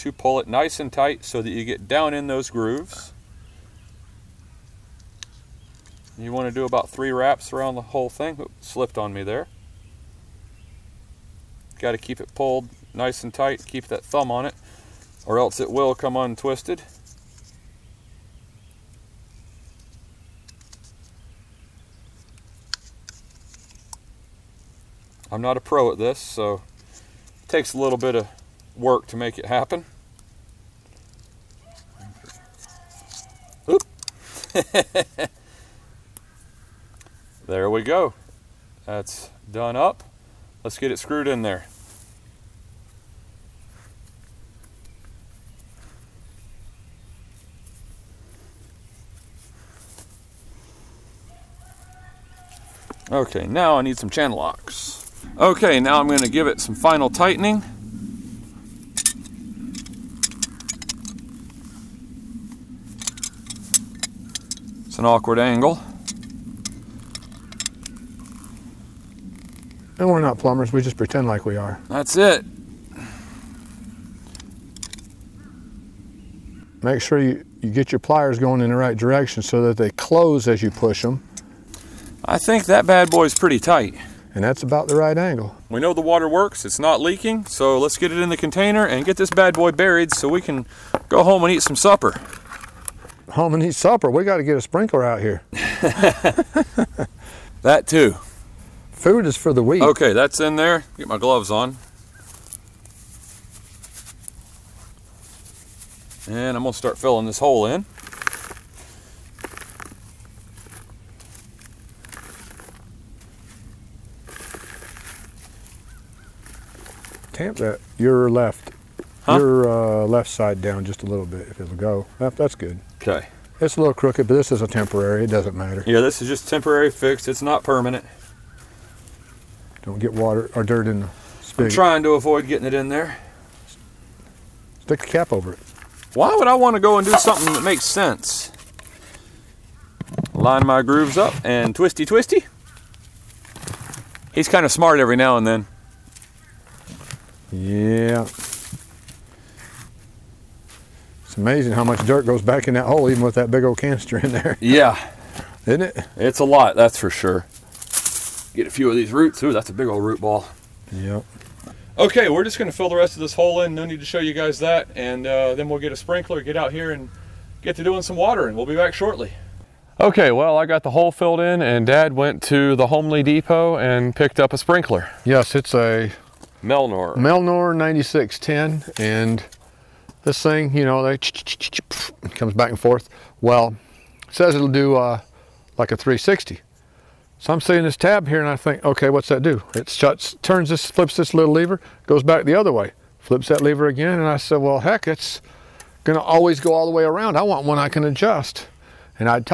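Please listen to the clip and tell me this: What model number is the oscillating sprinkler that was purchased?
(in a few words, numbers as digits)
9610.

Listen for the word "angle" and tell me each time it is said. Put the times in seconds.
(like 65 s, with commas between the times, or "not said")
65 s, 85 s.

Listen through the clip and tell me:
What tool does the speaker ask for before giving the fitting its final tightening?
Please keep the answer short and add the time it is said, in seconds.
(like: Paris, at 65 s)
Channel locks, at 54 s.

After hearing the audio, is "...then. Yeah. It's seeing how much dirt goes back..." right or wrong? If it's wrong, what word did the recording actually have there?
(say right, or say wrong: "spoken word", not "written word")
wrong: "amazing", not "seeing".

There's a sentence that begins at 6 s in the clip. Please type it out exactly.
You want to do about three wraps around the whole thing.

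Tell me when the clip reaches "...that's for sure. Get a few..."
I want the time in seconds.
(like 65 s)
156 s.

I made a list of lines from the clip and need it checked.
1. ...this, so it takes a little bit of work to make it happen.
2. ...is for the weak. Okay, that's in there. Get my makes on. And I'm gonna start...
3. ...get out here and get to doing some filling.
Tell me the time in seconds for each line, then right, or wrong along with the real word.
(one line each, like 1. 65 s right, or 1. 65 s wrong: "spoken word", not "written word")
1. 25 s right
2. 99 s wrong: "gloves", not "makes"
3. 166 s wrong: "watering", not "filling".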